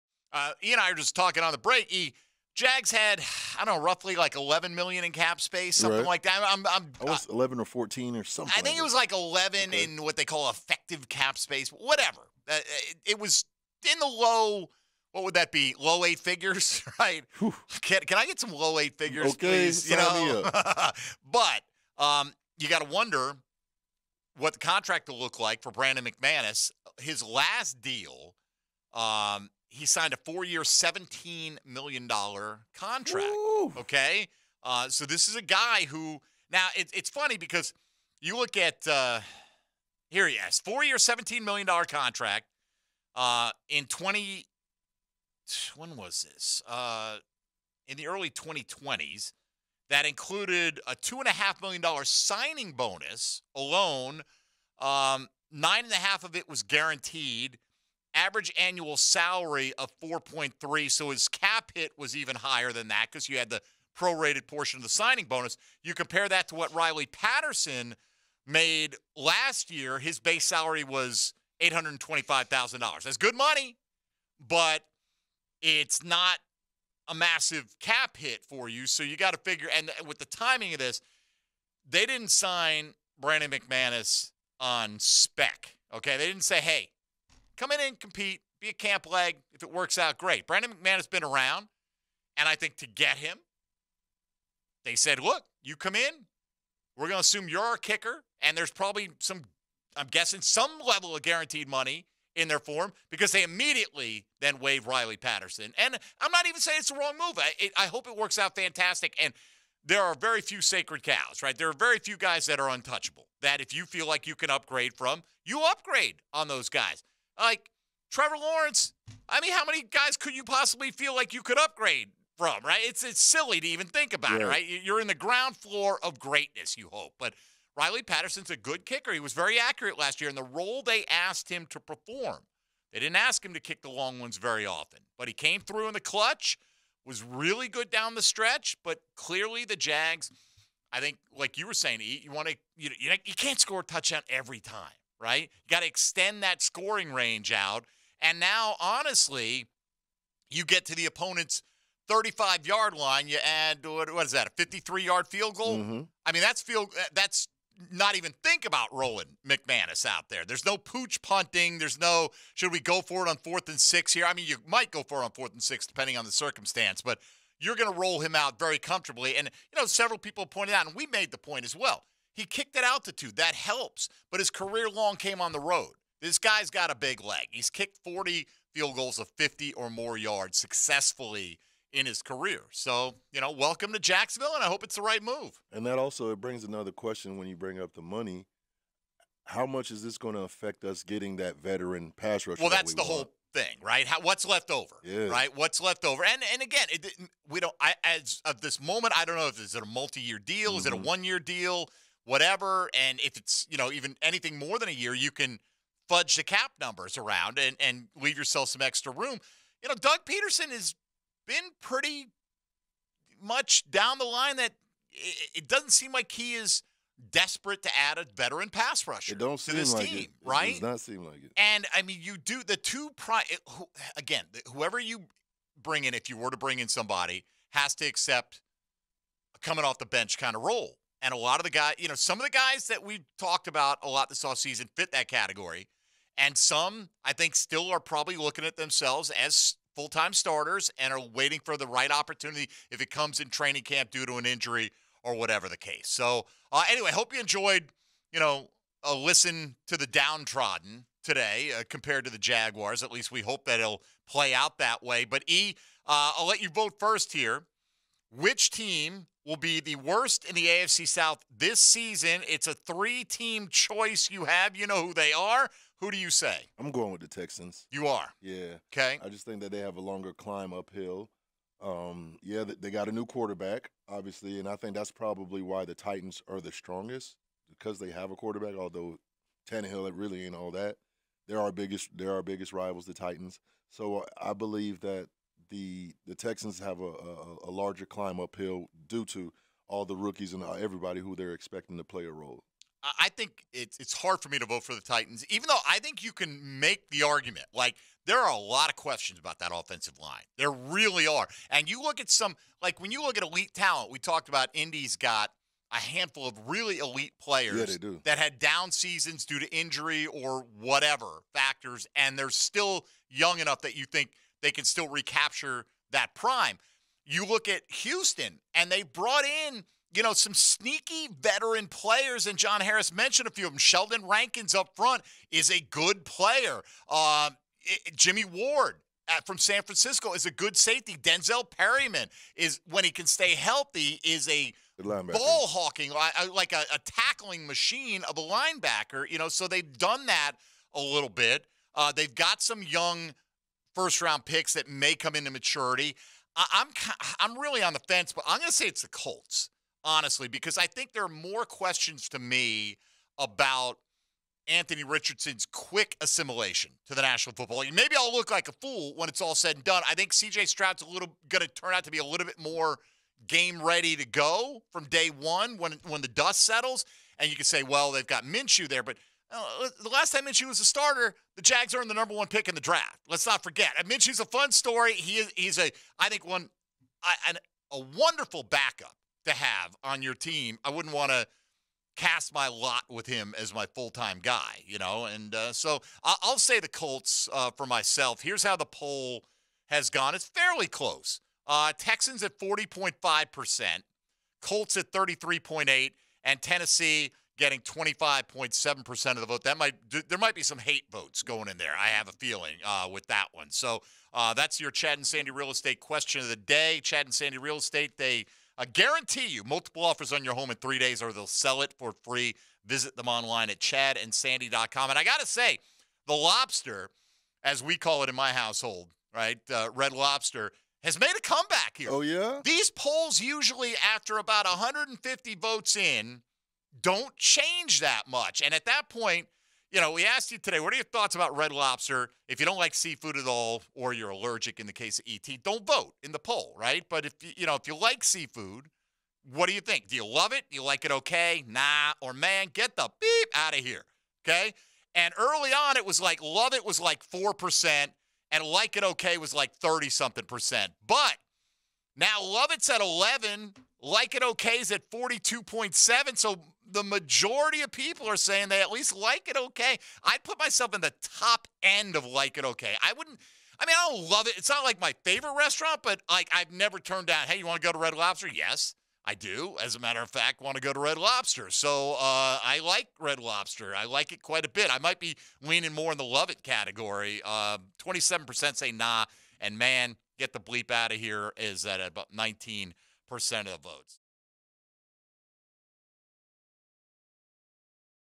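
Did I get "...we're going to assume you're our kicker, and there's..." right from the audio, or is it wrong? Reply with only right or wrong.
right.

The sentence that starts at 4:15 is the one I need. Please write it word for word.
But E, will uh, let you vote first here.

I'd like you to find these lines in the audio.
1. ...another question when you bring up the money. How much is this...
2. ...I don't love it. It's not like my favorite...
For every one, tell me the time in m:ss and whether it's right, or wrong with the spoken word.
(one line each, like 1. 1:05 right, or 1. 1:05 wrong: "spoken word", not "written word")
1. 3:06 right
2. 7:43 right.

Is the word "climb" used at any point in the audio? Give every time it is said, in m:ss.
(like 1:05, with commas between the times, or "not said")
4:30, 4:48.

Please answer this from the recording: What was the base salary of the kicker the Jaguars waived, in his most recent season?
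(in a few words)
$825,000.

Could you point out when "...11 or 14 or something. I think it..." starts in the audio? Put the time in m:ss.
0:07.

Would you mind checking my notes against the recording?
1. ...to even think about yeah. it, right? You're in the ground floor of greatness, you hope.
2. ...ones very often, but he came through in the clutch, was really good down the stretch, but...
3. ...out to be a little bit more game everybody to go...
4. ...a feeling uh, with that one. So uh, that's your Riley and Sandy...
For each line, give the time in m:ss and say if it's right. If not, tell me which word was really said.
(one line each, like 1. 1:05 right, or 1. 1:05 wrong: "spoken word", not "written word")
1. 2:03 right
2. 2:14 right
3. 6:01 wrong: "ready", not "everybody"
4. 6:42 wrong: "Chad", not "Riley".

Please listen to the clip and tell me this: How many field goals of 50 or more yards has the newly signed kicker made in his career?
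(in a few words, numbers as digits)
40.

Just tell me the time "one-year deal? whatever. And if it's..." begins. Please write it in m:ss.
3:21.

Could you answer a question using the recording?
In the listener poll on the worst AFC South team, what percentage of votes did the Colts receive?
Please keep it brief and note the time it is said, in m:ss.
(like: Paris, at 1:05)
33.8%, at 6:35.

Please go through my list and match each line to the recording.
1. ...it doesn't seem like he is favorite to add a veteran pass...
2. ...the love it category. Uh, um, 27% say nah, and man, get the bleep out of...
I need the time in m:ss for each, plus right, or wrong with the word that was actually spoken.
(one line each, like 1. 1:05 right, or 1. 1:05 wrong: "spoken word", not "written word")
1. 3:35 wrong: "desperate", not "favorite"
2. 7:56 right.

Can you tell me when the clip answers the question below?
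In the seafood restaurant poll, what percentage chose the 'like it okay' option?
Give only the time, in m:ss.
7:35.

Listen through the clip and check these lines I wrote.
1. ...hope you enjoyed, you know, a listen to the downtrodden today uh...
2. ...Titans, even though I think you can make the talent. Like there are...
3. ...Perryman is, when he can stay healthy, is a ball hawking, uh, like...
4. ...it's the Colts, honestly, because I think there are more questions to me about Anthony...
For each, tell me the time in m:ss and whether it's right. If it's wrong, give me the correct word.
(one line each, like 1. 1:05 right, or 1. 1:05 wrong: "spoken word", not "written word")
1. 4:07 right
2. 4:55 wrong: "argument", not "talent"
3. 5:31 right
4. 5:48 right.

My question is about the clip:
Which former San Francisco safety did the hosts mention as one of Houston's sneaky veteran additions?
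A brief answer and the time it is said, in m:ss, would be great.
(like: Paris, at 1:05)
Jimmy Ward, at 5:28.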